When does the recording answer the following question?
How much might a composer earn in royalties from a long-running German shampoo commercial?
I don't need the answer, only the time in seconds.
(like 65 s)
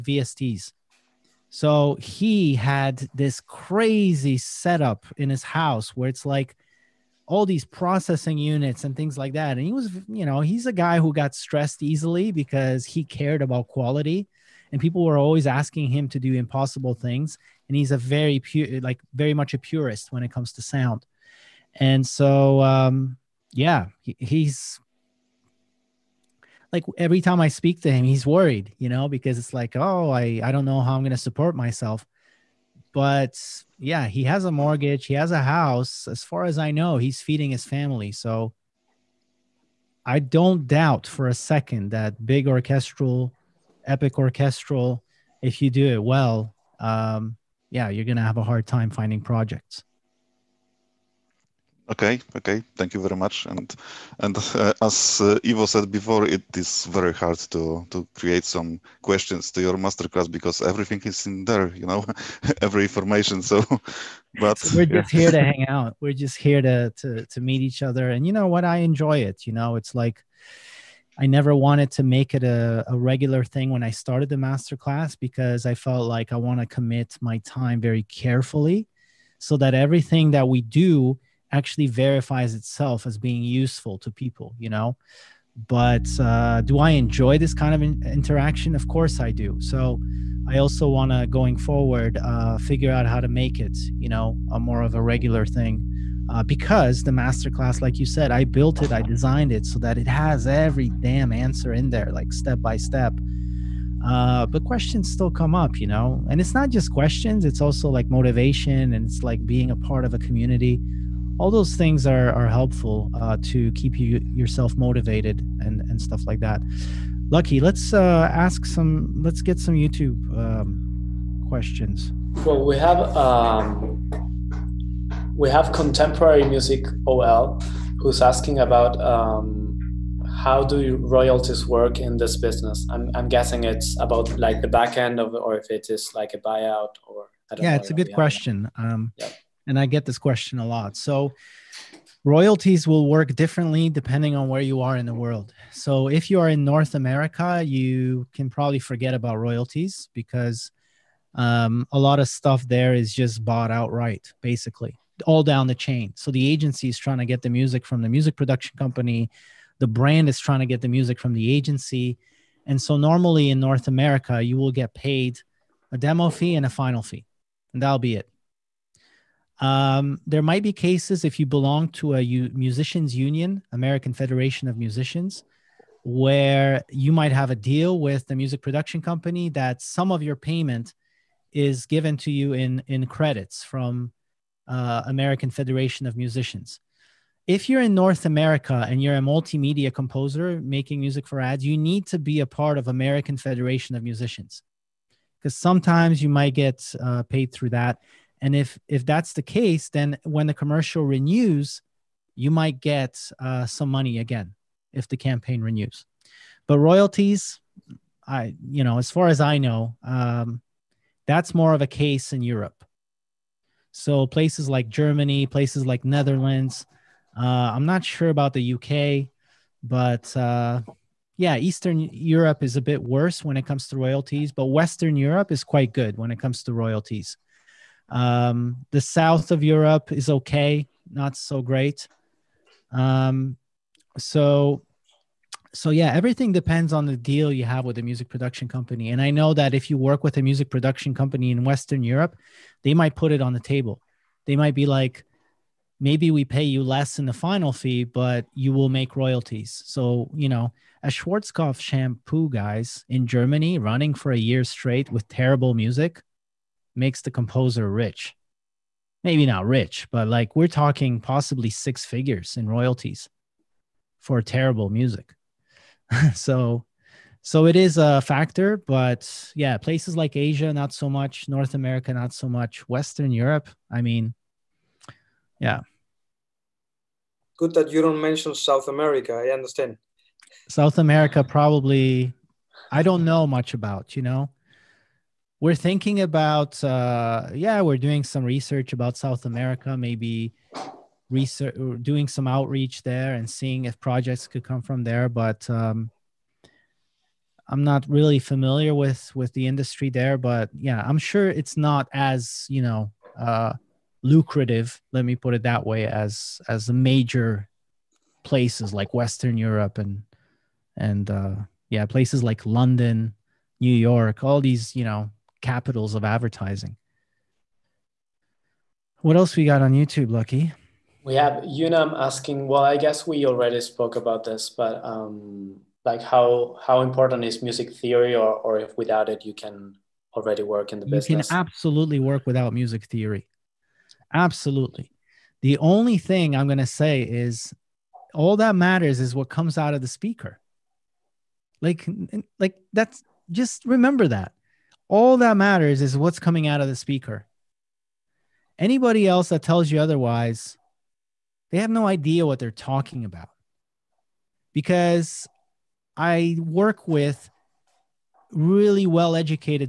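261 s.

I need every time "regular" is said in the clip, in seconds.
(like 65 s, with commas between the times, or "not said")
72 s, 95 s.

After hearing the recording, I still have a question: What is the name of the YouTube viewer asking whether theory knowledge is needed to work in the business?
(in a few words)
Unam.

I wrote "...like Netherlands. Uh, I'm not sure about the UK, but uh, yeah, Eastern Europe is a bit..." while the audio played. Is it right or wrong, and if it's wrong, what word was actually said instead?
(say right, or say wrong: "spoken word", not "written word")
right.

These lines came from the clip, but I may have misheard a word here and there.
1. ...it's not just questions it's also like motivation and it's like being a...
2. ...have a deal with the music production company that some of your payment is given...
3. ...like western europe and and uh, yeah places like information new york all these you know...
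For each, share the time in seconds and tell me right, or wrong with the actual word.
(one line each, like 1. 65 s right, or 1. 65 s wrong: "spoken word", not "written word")
1. 106 s right
2. 177 s right
3. 308 s wrong: "london", not "information".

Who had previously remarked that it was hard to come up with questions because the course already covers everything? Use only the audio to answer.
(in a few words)
Ivo.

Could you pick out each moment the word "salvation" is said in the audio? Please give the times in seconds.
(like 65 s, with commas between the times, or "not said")
not said.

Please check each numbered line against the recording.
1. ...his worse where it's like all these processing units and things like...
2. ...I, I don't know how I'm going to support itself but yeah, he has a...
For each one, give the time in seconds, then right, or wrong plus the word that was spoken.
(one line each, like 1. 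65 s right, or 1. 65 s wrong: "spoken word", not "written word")
1. 5 s wrong: "house", not "worse"
2. 30 s wrong: "myself", not "itself".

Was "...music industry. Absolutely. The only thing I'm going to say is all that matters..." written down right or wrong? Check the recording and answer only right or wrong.
wrong.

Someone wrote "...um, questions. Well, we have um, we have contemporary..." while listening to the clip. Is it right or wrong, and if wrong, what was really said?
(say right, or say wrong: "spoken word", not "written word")
right.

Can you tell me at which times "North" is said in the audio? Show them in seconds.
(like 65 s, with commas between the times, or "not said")
146 s, 163 s, 187 s, 271 s.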